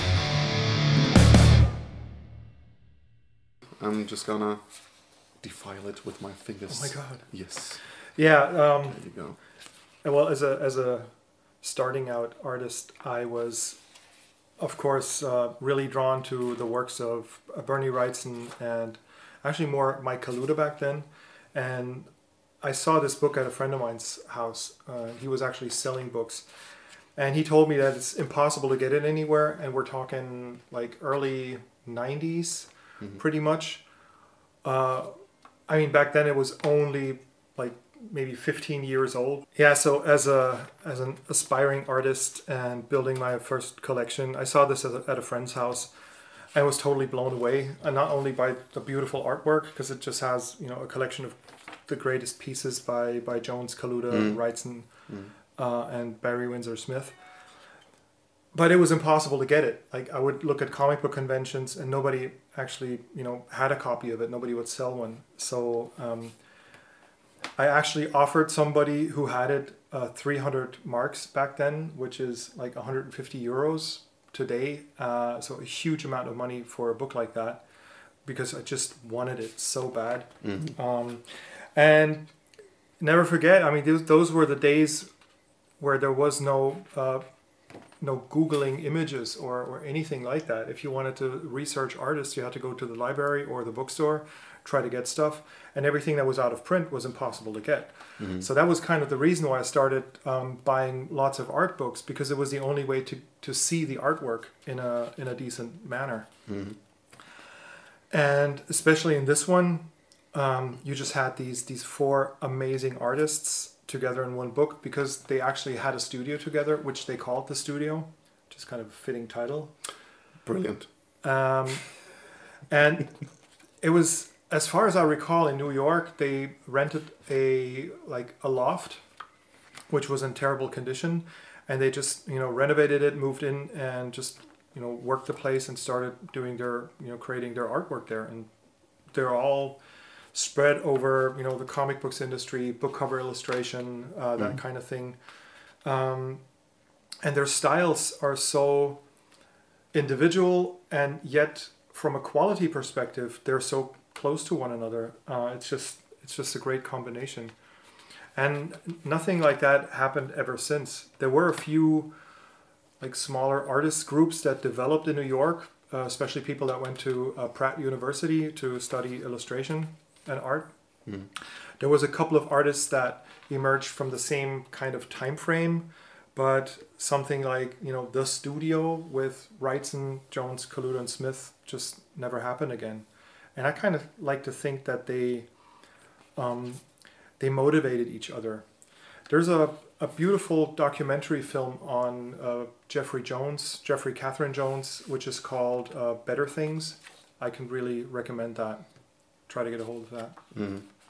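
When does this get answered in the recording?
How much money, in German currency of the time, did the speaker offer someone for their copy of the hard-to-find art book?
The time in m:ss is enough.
1:10.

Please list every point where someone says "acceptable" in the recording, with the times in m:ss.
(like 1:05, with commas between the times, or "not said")
not said.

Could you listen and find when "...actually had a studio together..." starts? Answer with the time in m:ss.
1:55.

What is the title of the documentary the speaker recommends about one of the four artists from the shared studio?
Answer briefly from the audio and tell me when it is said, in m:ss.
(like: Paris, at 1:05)
Better Things, at 3:16.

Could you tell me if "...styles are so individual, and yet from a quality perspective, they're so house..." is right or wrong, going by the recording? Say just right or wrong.
wrong.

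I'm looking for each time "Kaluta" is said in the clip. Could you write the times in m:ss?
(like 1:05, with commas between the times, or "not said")
0:20, 0:53, 3:00.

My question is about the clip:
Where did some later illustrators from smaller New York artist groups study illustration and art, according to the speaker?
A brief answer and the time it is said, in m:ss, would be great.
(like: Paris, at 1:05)
Pratt University, at 2:47.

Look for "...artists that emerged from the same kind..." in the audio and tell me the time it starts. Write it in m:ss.
2:52.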